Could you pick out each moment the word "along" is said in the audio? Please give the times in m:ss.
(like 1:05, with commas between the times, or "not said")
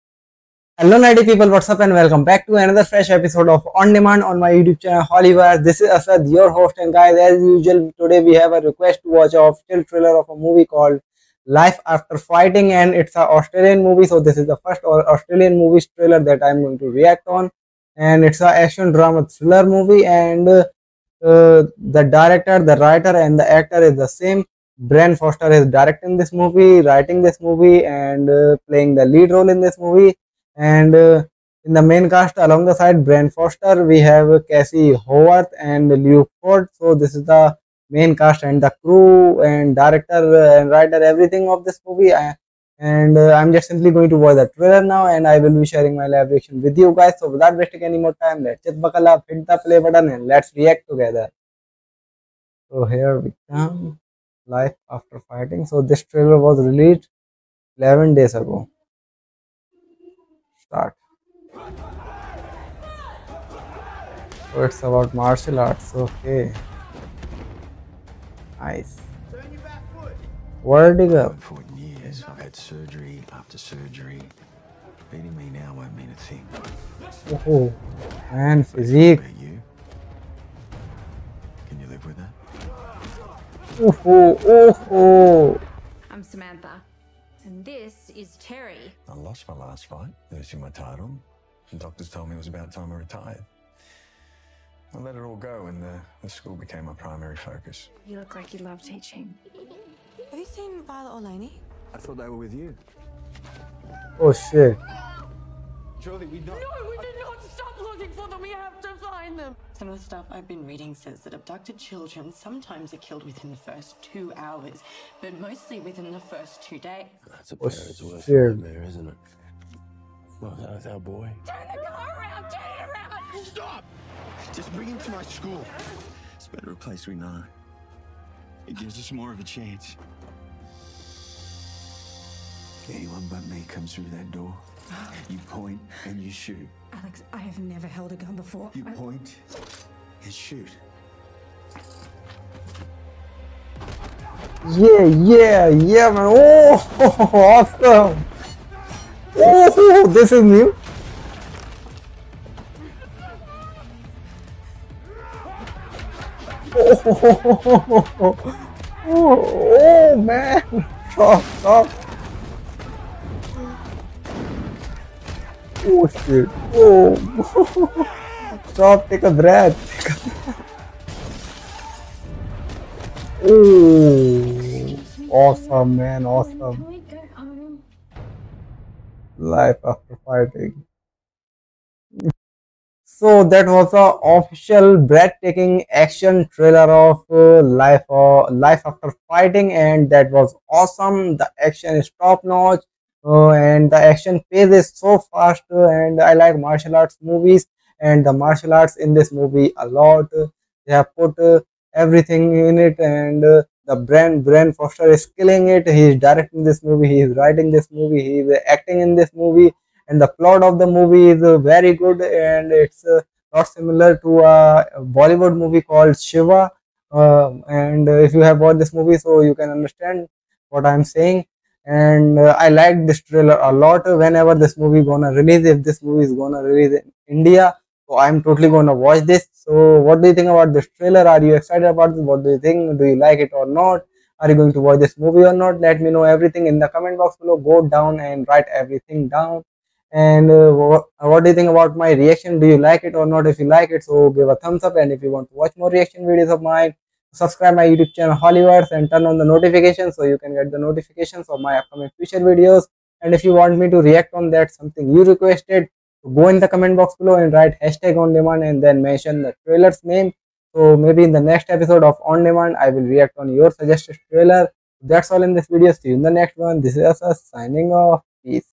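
0:32.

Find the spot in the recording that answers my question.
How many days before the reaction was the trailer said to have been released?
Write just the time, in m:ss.
0:57.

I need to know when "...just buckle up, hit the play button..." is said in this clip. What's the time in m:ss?
0:48.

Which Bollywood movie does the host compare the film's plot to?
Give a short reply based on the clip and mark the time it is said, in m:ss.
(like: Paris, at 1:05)
Shiva, at 3:36.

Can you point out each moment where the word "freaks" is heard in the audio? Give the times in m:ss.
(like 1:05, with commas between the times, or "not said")
not said.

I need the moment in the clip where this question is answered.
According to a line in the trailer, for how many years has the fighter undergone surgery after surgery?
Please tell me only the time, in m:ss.
1:11.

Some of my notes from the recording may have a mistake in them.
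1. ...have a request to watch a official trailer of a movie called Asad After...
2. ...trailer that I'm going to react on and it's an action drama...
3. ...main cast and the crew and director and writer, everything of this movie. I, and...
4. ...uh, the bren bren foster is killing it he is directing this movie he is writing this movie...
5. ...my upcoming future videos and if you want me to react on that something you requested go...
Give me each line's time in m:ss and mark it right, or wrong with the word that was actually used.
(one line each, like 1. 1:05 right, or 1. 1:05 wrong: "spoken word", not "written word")
1. 0:08 wrong: "Life", not "Asad"
2. 0:15 right
3. 0:37 right
4. 3:23 right
5. 4:11 right.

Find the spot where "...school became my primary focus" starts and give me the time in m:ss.
1:36.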